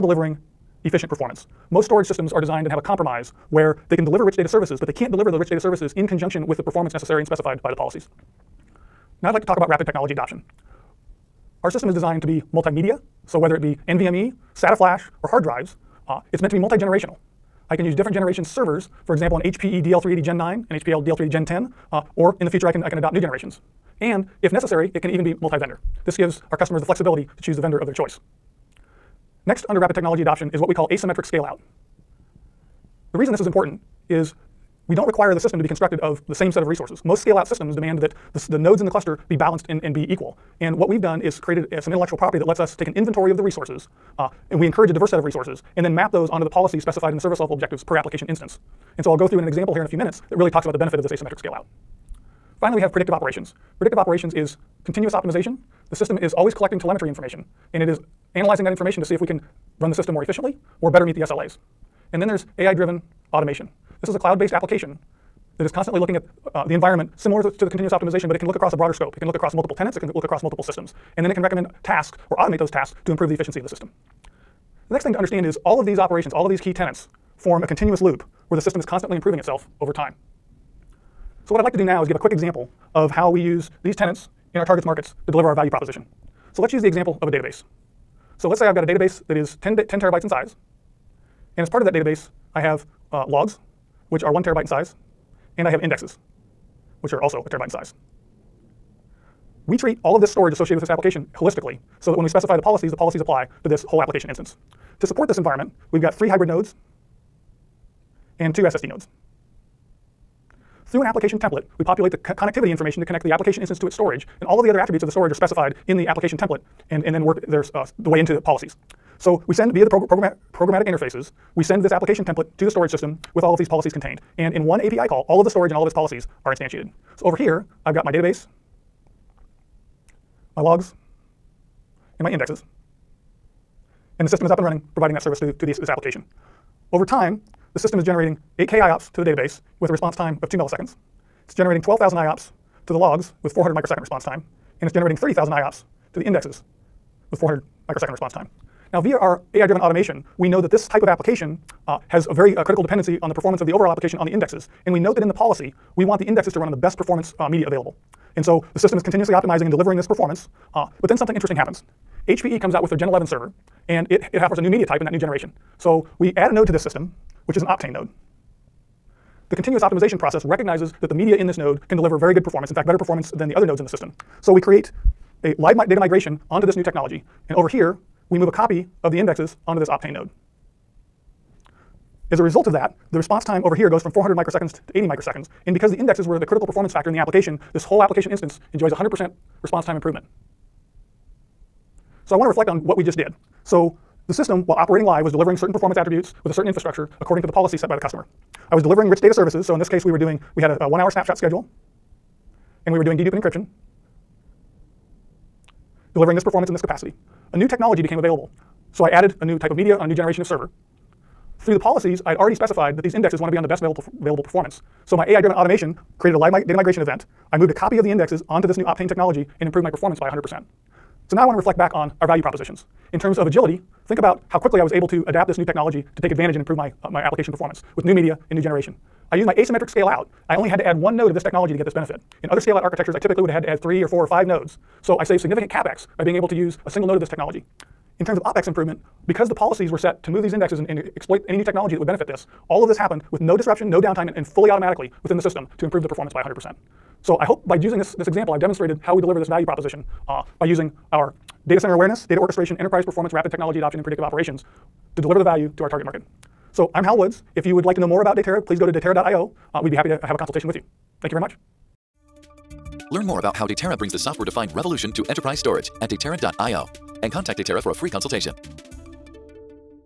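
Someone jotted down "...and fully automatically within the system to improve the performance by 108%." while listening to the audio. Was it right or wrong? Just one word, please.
wrong.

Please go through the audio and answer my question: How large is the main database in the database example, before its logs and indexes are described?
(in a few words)
10 terabytes.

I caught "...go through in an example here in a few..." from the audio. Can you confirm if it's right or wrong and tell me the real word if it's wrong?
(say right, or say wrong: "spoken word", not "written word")
right.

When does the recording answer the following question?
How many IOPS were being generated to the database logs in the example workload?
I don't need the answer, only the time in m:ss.
2:21.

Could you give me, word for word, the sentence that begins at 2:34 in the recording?
And we note that in the policy, we want the indexes to run on the best performance uh, media available.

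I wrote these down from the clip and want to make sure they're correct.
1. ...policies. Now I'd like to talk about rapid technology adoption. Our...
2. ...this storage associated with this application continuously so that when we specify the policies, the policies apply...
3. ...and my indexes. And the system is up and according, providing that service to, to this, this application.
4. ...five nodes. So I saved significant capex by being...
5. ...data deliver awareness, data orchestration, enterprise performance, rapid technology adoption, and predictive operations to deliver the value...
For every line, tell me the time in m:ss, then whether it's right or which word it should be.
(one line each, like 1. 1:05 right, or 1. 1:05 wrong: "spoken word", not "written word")
1. 0:07 right
2. 1:40 wrong: "holistically", not "continuously"
3. 2:12 wrong: "running", not "according"
4. 3:54 right
5. 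4:11 wrong: "center", not "deliver".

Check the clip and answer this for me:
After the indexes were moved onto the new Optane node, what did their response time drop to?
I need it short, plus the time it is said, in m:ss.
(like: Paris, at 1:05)
80 microseconds, at 3:04.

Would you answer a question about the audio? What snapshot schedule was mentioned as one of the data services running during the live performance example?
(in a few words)
one hour.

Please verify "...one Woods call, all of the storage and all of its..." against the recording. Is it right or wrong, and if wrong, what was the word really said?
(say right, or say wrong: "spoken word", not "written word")
wrong: "API", not "Woods".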